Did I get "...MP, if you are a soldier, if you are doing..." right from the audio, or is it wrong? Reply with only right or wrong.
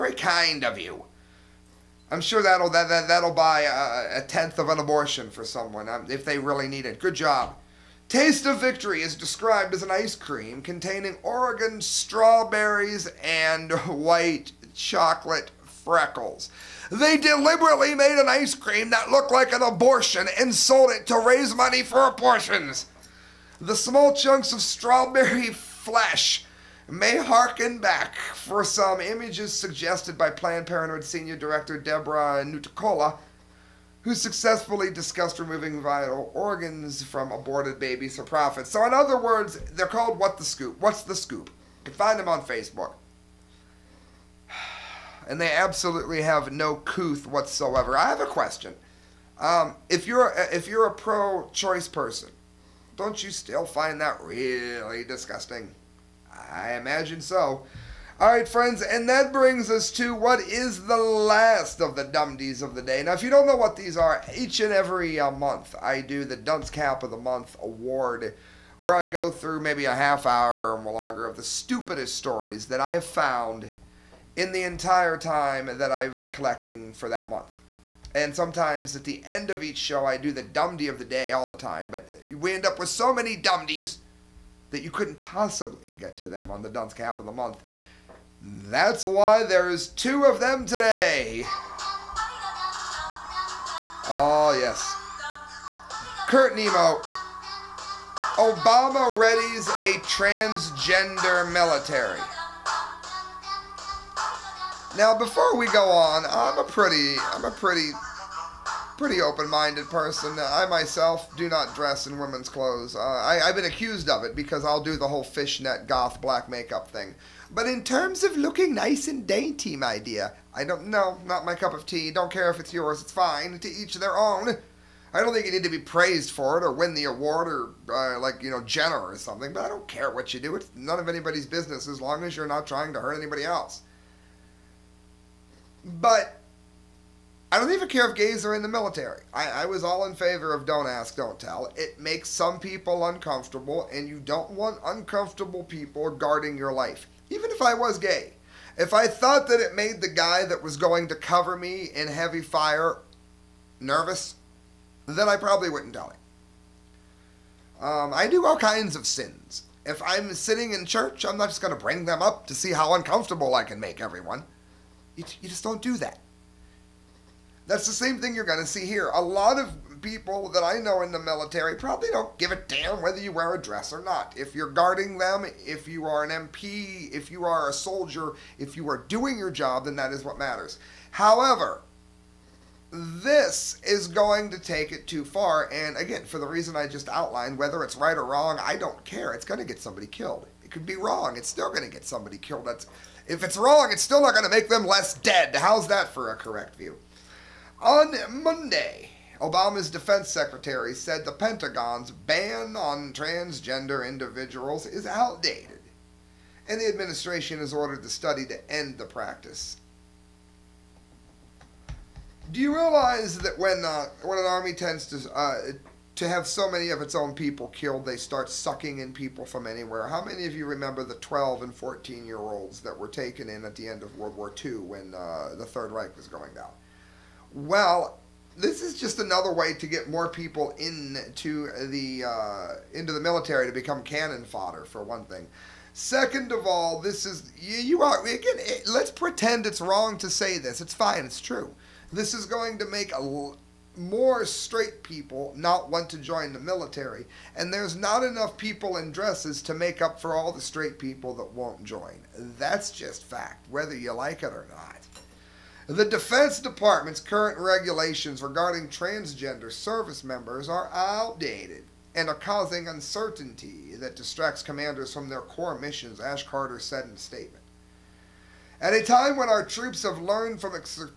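right.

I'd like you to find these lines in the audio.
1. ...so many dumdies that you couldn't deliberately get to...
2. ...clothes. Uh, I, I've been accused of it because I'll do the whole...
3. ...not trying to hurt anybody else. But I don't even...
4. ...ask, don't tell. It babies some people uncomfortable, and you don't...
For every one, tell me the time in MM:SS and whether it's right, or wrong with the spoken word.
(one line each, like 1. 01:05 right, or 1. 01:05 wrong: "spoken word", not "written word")
1. 01:22 wrong: "possibly", not "deliberately"
2. 01:52 right
3. 02:12 right
4. 02:20 wrong: "makes", not "babies".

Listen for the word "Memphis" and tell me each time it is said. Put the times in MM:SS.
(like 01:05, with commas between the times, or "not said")
not said.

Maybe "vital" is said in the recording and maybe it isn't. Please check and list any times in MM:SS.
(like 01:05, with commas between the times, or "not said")
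00:35.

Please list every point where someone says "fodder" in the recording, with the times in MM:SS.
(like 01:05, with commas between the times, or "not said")
03:54.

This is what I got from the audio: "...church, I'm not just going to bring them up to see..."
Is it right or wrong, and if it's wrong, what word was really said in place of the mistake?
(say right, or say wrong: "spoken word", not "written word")
right.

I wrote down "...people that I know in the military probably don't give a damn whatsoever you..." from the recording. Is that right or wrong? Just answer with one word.
wrong.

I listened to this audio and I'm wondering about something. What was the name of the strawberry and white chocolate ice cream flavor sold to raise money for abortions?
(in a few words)
Taste of Victory.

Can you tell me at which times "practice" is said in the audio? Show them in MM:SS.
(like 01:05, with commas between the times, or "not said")
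03:29.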